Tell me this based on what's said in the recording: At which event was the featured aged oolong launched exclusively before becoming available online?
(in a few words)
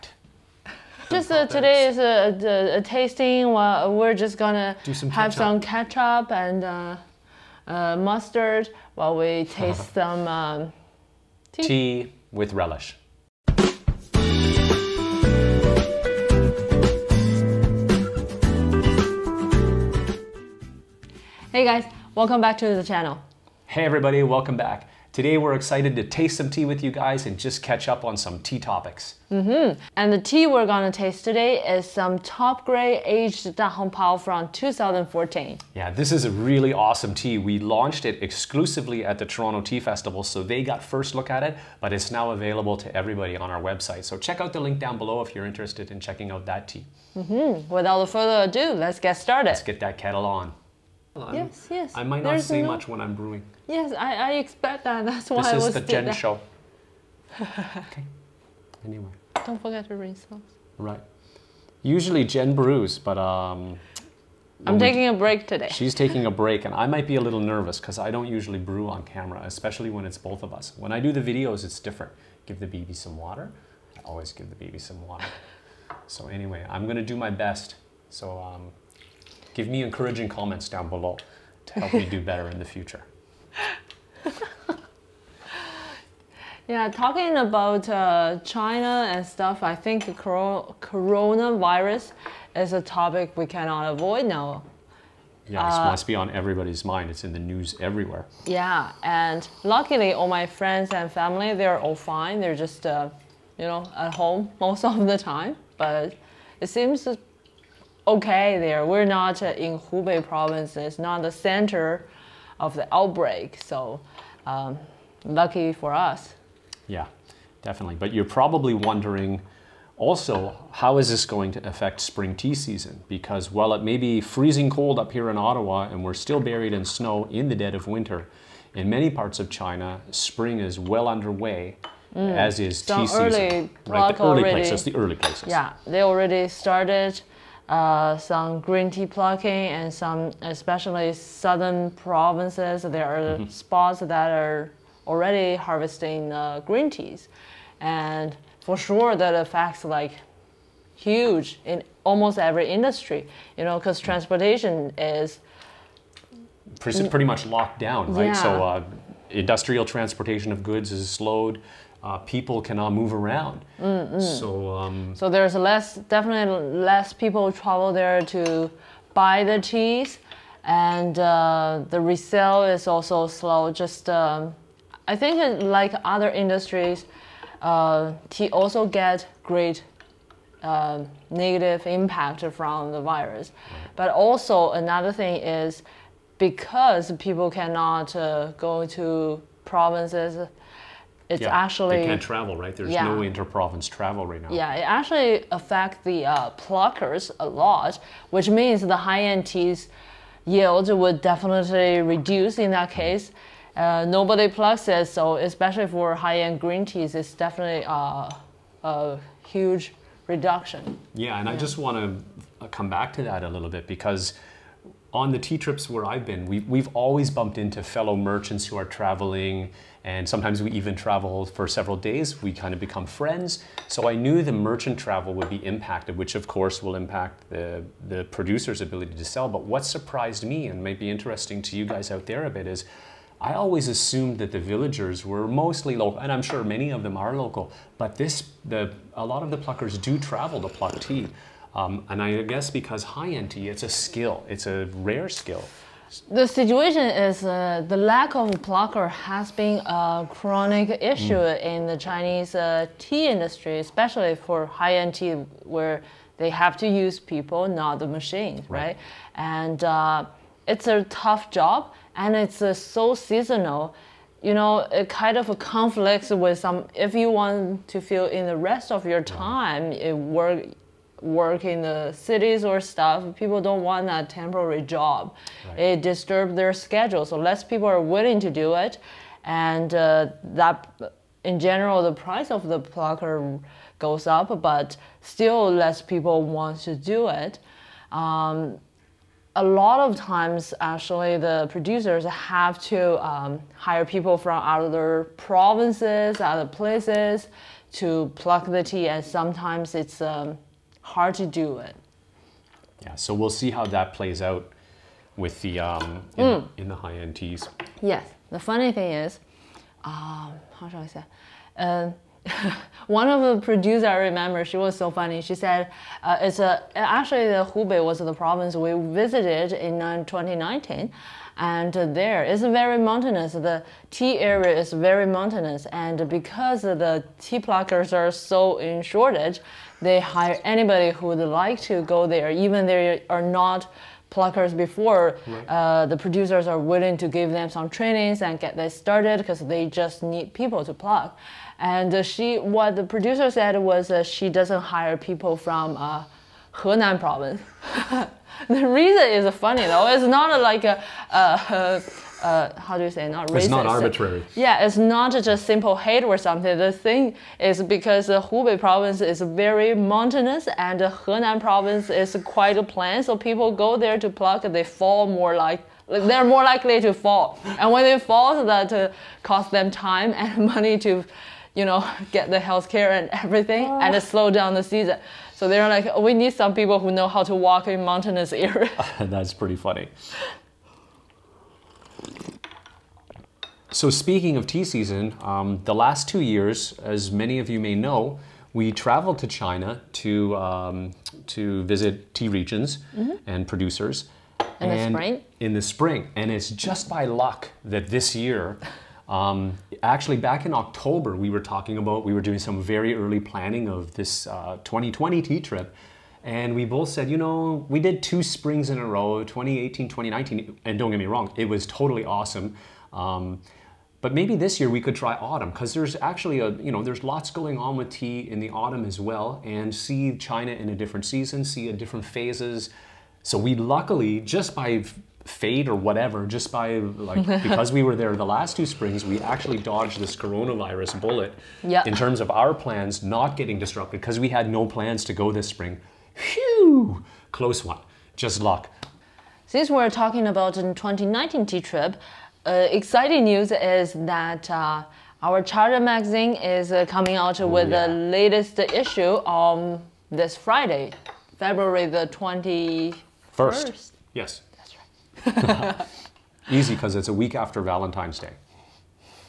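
Toronto Tea Festival.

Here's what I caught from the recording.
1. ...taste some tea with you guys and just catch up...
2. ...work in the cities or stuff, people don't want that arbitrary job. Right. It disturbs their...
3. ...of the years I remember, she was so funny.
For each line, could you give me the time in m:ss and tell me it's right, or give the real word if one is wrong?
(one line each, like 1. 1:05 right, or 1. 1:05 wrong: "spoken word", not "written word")
1. 0:26 right
2. 4:31 wrong: "temporary", not "arbitrary"
3. 5:13 wrong: "producers", not "years".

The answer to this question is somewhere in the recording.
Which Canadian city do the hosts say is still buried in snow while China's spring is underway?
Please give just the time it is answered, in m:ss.
2:05.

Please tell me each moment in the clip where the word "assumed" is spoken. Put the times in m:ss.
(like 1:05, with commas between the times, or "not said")
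3:53.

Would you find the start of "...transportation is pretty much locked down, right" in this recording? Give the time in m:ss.
2:34.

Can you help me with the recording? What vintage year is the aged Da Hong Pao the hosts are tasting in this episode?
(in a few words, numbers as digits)
2014.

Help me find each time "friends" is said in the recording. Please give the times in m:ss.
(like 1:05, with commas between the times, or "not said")
1:40, 3:43.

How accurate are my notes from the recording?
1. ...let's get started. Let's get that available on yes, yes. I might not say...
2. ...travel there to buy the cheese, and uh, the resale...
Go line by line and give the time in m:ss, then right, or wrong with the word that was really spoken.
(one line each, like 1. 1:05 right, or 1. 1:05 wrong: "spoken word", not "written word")
1. 0:48 wrong: "kettle", not "available"
2. 2:47 right.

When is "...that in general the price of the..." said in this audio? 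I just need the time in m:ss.
4:40.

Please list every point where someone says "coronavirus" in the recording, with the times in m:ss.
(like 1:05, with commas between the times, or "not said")
1:30, 7:10.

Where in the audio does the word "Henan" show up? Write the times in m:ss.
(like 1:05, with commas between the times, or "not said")
5:46, 6:01.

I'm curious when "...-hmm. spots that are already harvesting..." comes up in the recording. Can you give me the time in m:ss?
2:23.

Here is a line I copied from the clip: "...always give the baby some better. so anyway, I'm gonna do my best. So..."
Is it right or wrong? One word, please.
wrong.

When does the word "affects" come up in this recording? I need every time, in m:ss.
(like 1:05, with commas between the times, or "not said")
2:01, 2:29, 3:15.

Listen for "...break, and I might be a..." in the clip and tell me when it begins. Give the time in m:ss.
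1:06.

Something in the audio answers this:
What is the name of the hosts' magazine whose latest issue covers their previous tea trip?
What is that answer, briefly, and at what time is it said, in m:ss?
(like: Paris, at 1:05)
Charen, at 7:25.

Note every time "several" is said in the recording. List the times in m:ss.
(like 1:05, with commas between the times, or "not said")
3:41.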